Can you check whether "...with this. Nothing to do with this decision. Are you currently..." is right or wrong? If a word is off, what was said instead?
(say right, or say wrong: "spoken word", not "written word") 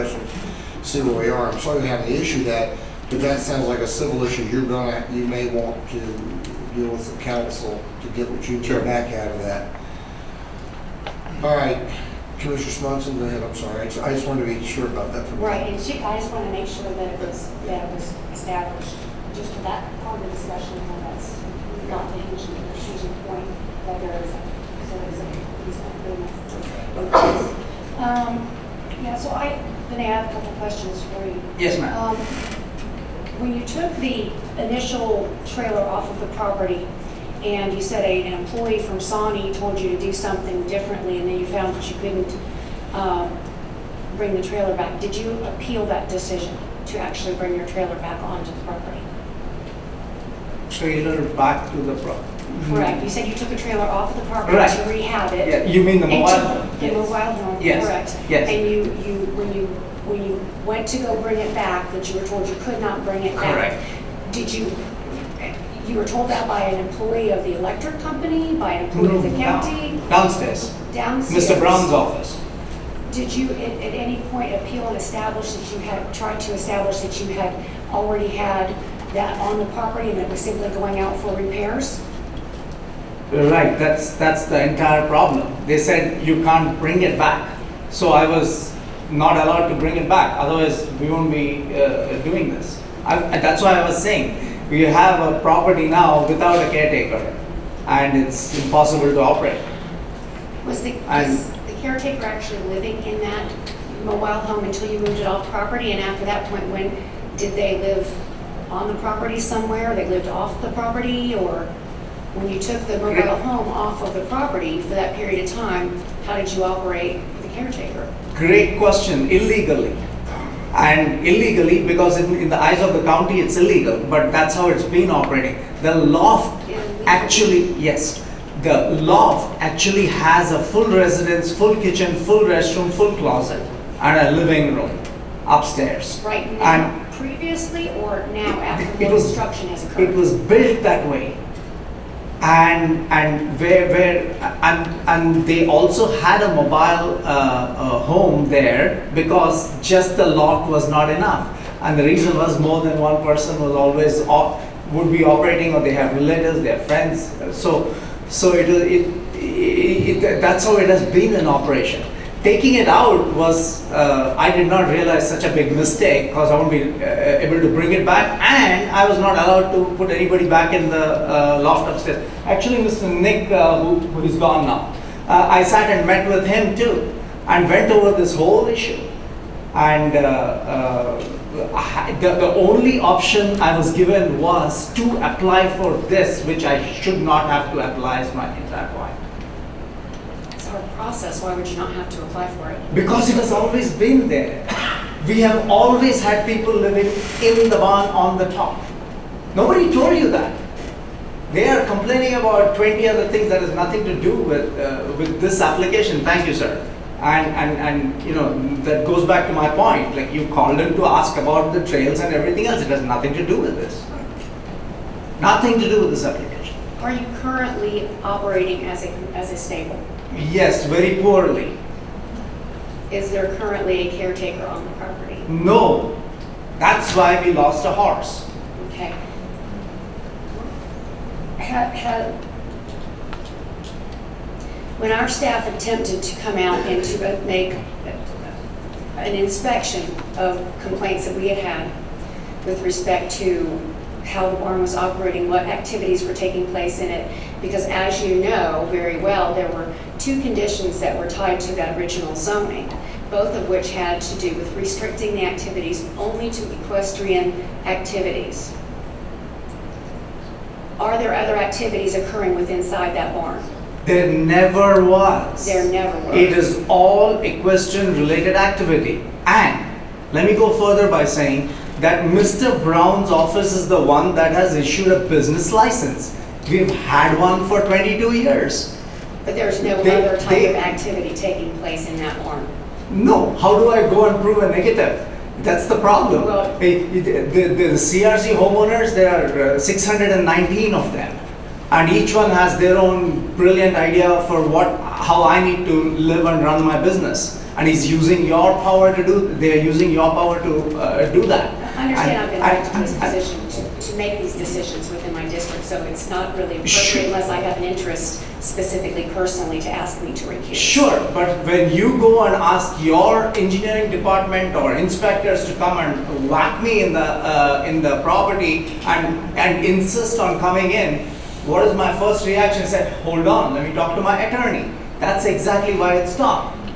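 wrong: "application", not "decision".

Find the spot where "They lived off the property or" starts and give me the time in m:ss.
1:49.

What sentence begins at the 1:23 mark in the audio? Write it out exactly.
Right, that's, that's the entire problem.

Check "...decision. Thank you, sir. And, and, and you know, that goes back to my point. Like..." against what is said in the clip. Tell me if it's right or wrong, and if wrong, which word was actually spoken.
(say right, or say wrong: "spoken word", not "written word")
wrong: "application", not "decision".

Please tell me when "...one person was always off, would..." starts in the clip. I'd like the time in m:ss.
2:32.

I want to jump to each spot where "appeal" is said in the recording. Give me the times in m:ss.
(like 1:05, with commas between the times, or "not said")
0:45, 1:14.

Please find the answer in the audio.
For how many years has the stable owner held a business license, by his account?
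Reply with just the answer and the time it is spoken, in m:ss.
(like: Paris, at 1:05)
22 years, at 4:37.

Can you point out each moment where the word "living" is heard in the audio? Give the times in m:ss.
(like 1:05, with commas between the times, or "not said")
1:42, 2:14, 3:16.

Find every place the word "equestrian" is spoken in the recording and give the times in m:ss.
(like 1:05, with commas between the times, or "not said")
4:16, 4:27.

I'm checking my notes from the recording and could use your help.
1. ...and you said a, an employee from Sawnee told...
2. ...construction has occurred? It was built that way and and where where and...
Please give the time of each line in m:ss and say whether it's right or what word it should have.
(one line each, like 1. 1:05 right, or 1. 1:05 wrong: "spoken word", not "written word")
1. 0:37 right
2. 2:19 right.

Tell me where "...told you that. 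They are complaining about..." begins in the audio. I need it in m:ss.
3:19.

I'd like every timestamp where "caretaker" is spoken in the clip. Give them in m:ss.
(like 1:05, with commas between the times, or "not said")
1:36, 1:41, 1:57, 3:44.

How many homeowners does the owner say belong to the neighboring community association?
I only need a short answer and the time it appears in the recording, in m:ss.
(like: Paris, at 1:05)
619, at 4:49.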